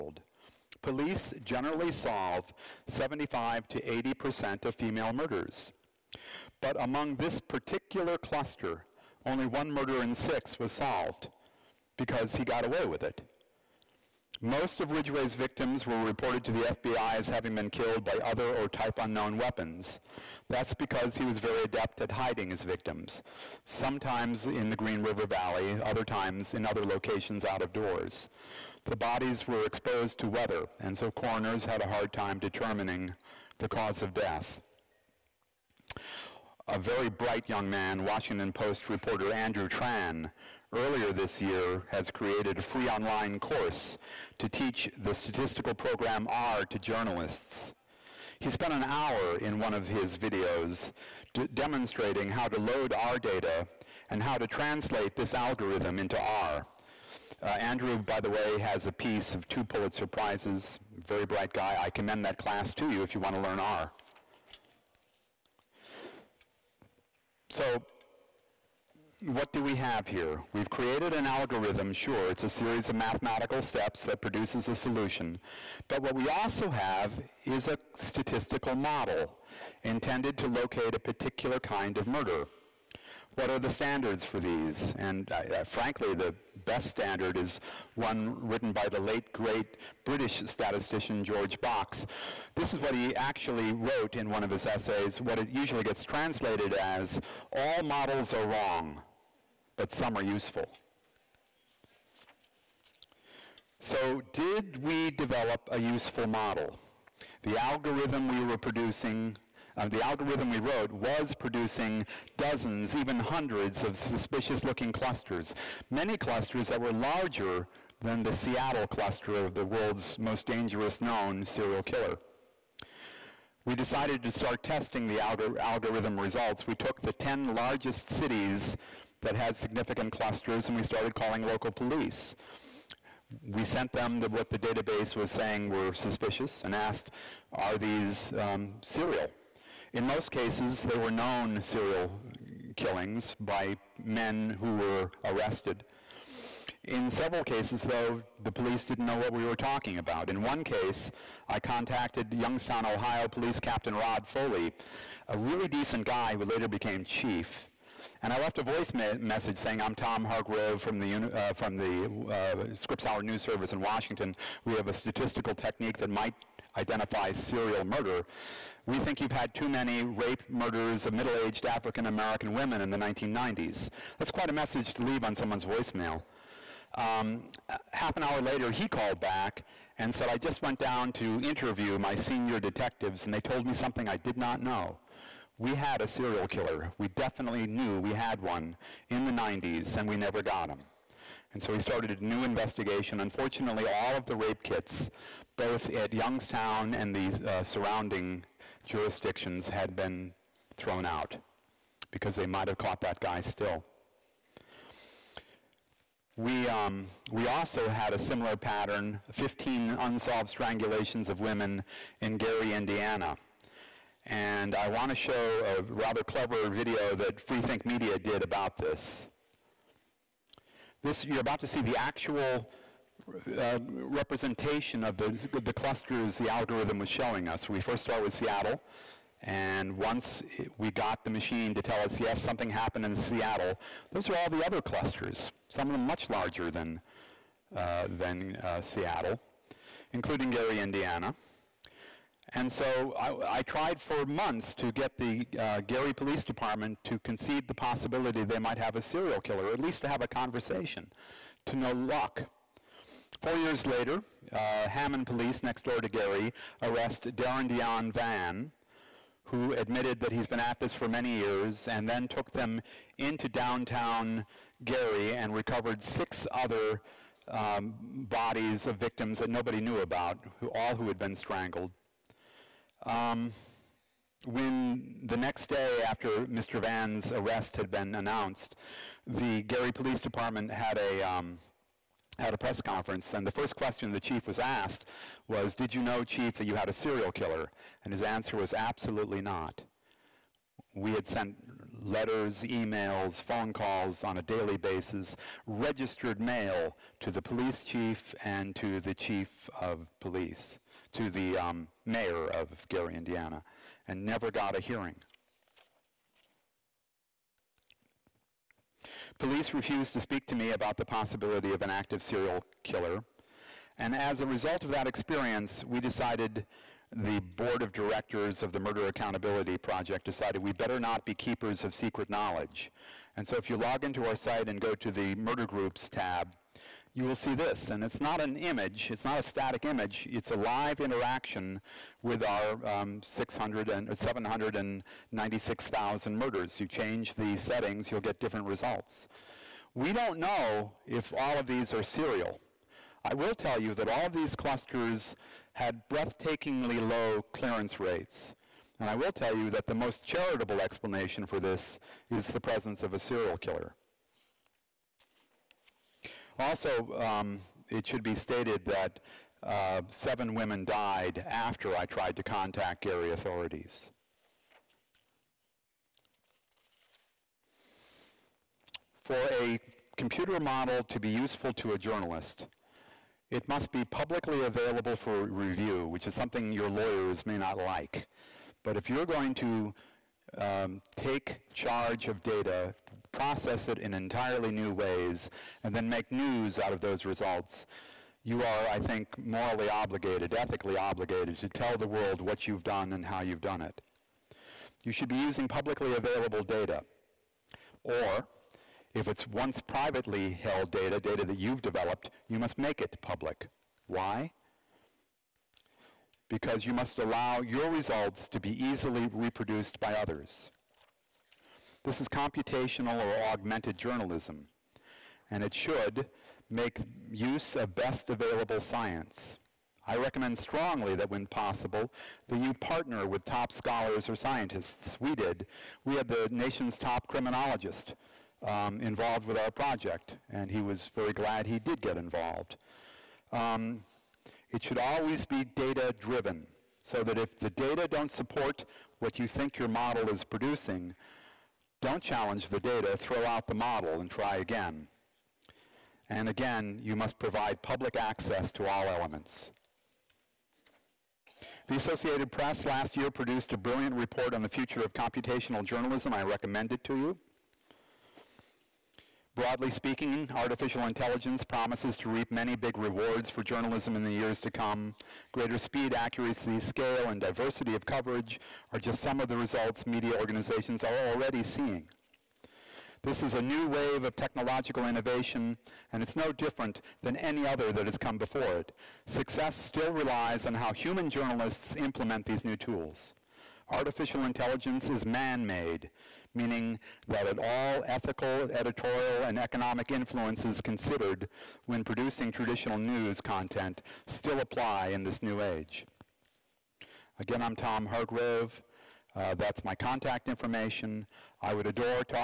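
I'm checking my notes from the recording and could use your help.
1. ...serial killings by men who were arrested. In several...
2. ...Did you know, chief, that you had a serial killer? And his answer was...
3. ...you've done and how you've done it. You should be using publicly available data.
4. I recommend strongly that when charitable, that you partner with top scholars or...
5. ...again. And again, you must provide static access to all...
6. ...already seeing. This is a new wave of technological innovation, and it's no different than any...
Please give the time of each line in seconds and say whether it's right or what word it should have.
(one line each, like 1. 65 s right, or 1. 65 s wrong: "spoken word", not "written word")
1. 141 s right
2. 285 s right
3. 392 s right
4. 420 s wrong: "possible", not "charitable"
5. 444 s wrong: "public", not "static"
6. 471 s right.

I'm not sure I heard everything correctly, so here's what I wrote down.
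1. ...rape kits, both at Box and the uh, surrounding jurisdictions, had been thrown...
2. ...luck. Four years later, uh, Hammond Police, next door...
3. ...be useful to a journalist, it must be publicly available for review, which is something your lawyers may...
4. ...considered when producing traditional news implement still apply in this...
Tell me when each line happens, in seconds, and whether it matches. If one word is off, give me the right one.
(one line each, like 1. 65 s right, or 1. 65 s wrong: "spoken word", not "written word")
1. 194 s wrong: "Youngstown", not "Box"
2. 251 s right
3. 371 s right
4. 490 s wrong: "content", not "implement".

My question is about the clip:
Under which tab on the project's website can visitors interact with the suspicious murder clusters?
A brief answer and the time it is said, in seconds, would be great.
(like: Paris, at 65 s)
murder groups, at 325 s.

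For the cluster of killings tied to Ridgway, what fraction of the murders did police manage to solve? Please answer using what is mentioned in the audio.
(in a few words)
1 in 6.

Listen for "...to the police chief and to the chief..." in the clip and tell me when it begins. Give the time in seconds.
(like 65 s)
297 s.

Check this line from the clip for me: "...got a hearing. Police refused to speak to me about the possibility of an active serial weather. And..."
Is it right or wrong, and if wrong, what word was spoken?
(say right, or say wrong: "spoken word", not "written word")
wrong: "killer", not "weather".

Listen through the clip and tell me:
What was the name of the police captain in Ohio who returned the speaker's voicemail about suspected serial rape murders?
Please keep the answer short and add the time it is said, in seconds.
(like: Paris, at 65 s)
Rod Foley, at 153 s.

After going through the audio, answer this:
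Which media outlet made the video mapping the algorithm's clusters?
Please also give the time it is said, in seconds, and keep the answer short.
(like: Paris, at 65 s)
Freethink Media, at 217 s.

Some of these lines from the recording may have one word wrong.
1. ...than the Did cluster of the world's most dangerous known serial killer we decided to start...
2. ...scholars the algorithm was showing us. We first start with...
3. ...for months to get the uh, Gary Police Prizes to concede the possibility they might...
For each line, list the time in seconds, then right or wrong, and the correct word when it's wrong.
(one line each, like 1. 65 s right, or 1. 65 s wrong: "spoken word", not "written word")
1. 118 s wrong: "Seattle", not "Did"
2. 225 s wrong: "clusters", not "scholars"
3. 244 s wrong: "Department", not "Prizes".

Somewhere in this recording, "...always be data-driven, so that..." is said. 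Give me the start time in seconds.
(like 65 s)
434 s.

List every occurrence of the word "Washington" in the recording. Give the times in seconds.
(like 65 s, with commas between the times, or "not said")
38 s, 163 s.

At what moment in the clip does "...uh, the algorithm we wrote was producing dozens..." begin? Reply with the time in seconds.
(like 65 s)
109 s.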